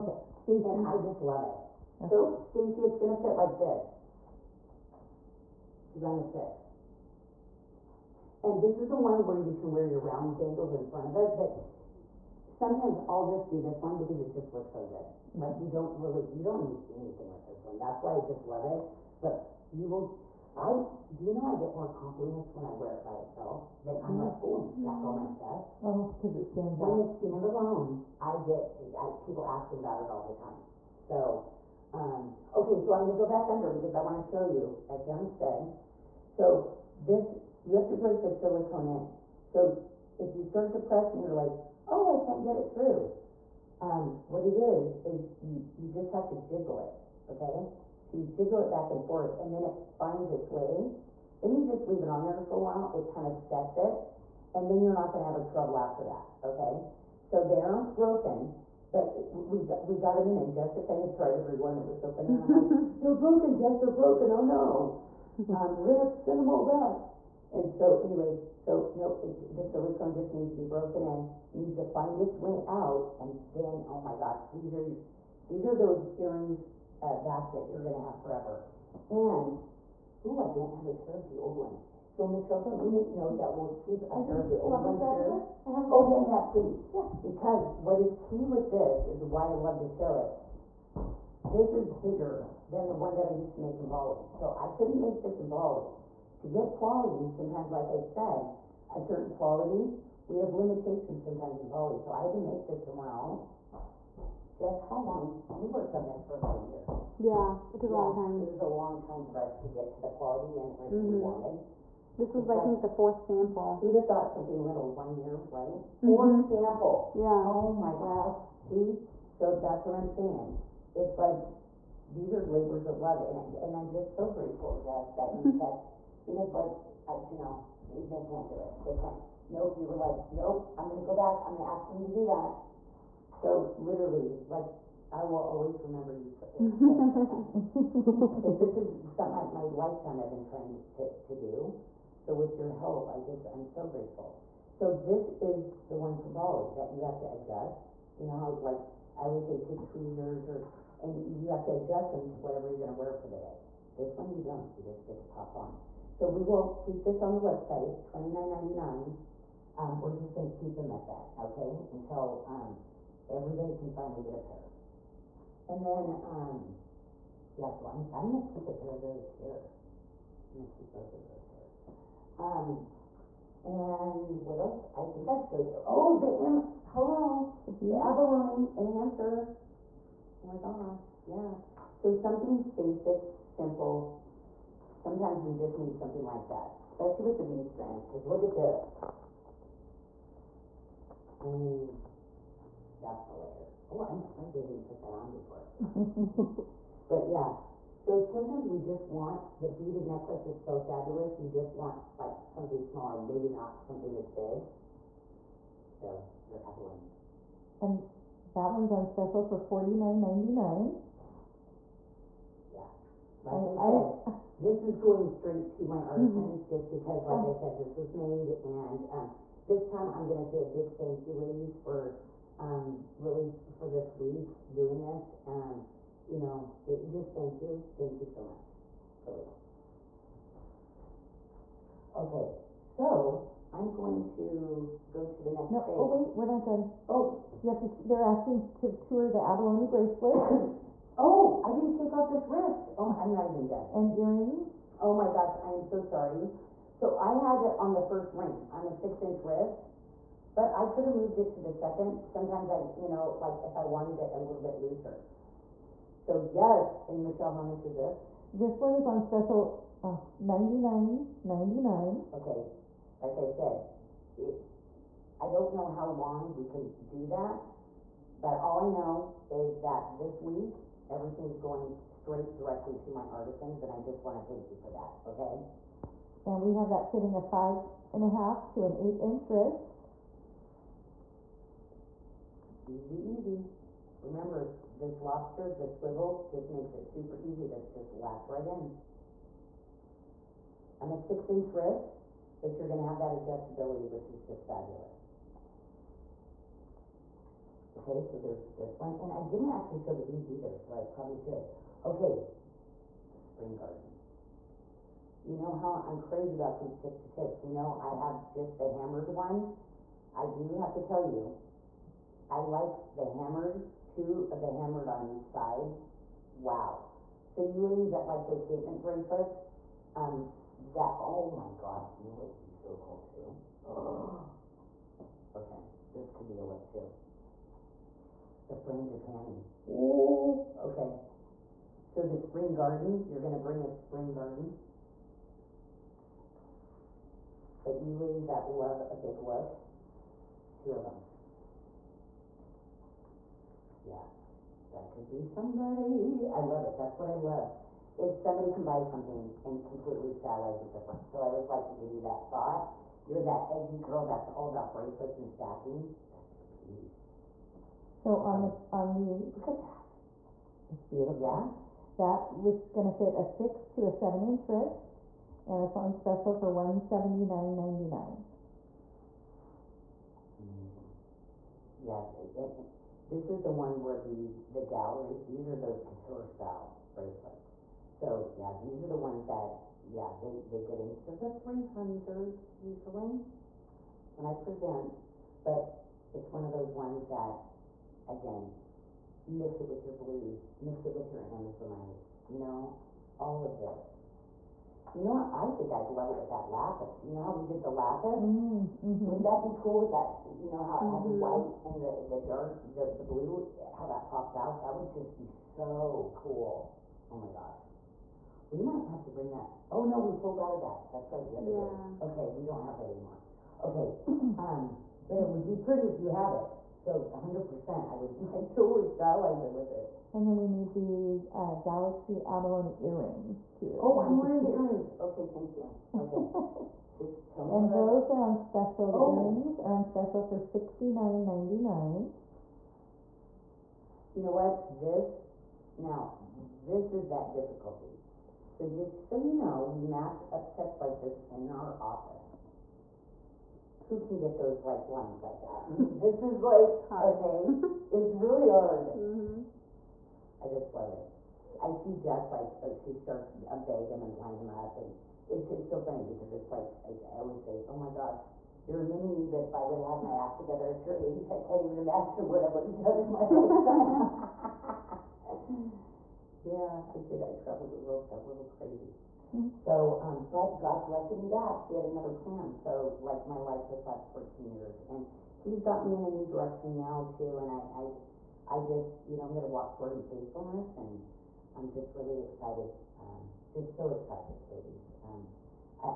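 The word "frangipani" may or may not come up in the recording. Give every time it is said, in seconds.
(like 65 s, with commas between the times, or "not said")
328 s.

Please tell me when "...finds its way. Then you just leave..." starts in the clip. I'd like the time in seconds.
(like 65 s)
49 s.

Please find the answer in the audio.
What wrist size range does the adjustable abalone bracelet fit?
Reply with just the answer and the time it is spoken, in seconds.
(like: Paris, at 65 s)
5.5 to 8 inches, at 277 s.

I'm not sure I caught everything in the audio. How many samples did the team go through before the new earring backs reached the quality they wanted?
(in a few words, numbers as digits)
4.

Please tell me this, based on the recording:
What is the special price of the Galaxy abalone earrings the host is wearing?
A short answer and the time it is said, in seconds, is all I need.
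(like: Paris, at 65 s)
$69.99, at 430 s.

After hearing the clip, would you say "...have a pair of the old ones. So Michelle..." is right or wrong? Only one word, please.
right.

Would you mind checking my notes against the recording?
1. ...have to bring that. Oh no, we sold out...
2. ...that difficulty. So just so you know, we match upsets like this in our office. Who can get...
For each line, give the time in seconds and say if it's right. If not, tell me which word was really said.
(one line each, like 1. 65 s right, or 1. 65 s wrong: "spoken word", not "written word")
1. 409 s right
2. 437 s right.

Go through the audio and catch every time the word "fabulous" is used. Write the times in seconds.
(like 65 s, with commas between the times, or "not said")
200 s, 294 s.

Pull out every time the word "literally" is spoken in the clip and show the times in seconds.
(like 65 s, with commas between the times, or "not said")
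133 s.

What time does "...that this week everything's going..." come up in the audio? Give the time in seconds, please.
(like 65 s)
269 s.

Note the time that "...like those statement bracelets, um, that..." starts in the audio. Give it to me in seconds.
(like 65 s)
318 s.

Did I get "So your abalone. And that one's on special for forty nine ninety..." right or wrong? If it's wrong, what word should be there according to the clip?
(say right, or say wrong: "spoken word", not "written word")
right.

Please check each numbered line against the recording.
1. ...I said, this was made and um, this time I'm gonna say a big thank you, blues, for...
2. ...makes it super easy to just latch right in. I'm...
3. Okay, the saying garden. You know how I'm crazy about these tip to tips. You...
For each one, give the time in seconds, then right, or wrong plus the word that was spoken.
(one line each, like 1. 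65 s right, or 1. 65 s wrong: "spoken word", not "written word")
1. 217 s wrong: "ladies", not "blues"
2. 286 s right
3. 302 s wrong: "spring", not "saying".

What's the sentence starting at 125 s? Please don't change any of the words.
kept because like I, you know they, they can't do it.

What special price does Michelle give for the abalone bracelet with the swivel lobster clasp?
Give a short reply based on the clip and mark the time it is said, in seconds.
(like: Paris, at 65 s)
$99.99, at 260 s.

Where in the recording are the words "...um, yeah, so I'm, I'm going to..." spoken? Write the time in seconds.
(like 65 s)
166 s.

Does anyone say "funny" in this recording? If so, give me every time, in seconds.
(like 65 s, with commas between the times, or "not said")
62 s, 456 s.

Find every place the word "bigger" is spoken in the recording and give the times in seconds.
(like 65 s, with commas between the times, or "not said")
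92 s.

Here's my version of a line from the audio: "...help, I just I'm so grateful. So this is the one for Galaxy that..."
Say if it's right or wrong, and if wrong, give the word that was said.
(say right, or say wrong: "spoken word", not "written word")
wrong: "Bali", not "Galaxy".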